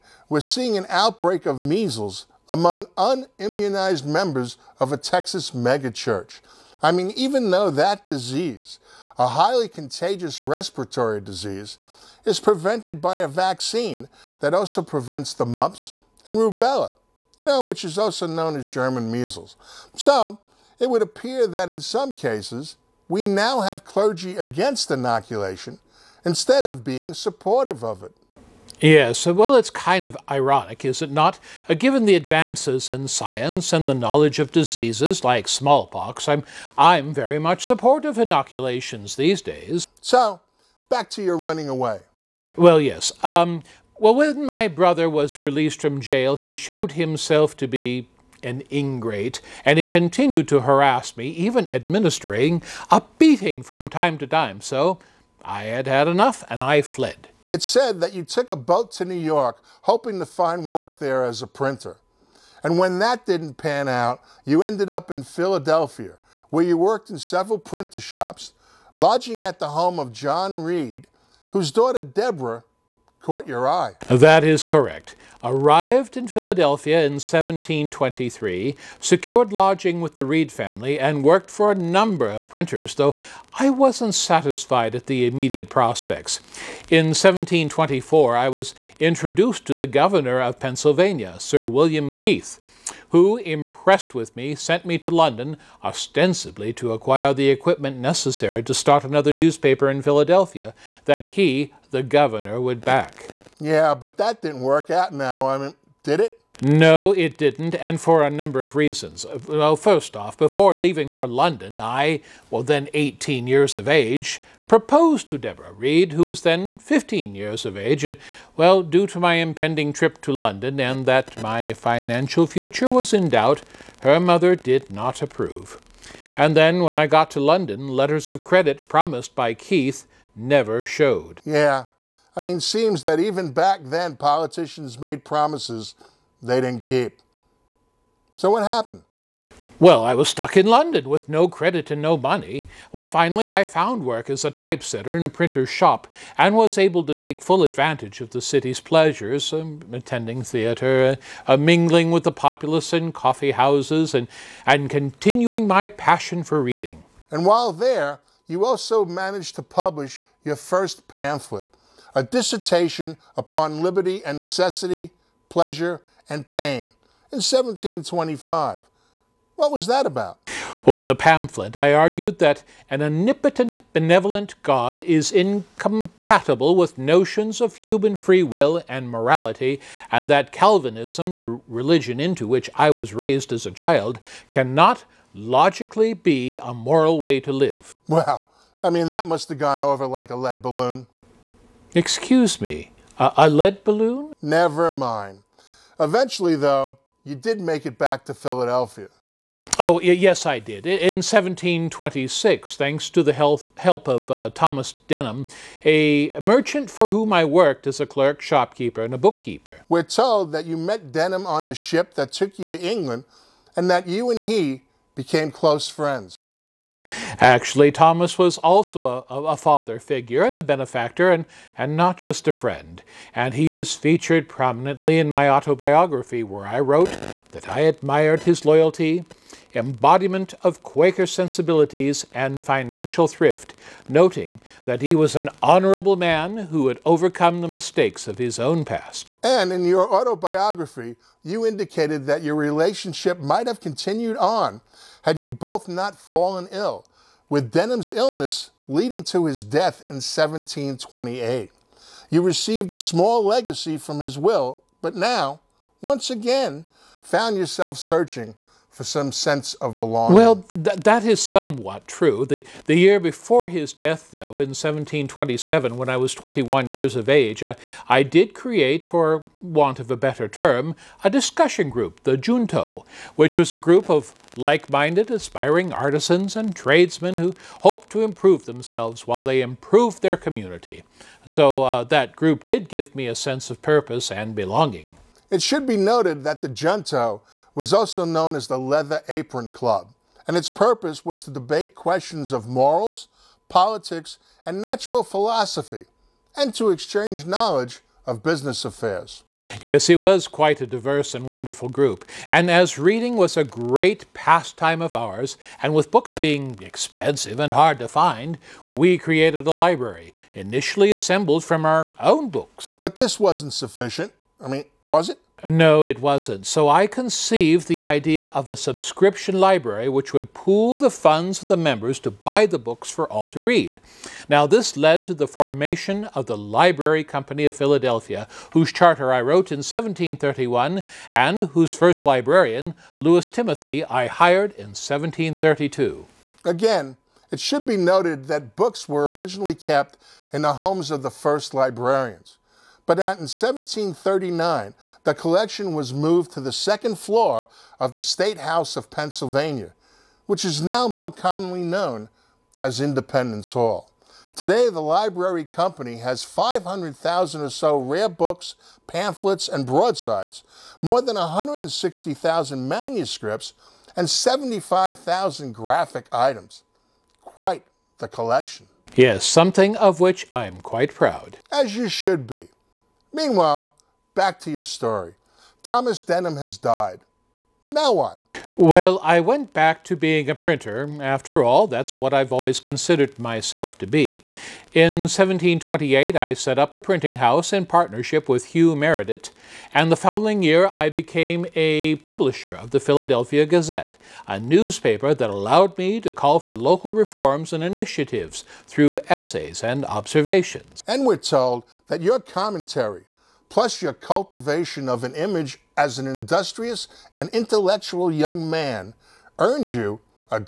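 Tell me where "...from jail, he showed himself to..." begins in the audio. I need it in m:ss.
0:45.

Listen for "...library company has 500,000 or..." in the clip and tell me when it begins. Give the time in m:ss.
5:54.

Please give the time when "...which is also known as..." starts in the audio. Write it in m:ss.
0:17.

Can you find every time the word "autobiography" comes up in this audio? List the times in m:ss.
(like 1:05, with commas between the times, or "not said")
3:45, 4:00.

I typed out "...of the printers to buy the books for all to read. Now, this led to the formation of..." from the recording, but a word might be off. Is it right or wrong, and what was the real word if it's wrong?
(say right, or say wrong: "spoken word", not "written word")
wrong: "members", not "printers".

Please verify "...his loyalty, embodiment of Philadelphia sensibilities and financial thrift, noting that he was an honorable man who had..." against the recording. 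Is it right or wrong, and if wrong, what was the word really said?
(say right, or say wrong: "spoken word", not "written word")
wrong: "Quaker", not "Philadelphia".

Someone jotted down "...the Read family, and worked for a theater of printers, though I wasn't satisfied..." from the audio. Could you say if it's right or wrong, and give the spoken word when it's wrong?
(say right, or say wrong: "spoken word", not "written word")
wrong: "number", not "theater".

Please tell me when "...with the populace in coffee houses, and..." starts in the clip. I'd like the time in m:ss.
2:32.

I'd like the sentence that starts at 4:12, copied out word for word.
You received a small legacy from his will, but now, once again, found yourself searching for some sense of belonging.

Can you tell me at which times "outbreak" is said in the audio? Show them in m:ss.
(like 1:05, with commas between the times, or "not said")
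0:00.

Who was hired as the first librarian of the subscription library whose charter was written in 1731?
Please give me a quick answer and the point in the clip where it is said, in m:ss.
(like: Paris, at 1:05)
Lewis Timothy, at 5:33.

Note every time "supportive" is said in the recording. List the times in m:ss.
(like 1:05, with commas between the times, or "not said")
0:27, 0:37.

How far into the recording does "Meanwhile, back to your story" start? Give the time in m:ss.
6:13.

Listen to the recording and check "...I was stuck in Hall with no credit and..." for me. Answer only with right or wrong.
wrong.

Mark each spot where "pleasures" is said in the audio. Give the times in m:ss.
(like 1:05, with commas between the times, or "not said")
2:28, 2:45.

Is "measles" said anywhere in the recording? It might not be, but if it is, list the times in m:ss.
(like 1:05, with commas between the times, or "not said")
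0:01, 0:19.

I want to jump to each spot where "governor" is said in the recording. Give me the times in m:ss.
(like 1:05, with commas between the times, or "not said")
1:29, 1:42.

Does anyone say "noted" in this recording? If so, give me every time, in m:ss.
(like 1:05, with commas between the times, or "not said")
4:45, 5:37.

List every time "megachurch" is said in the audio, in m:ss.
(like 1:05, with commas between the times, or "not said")
0:05.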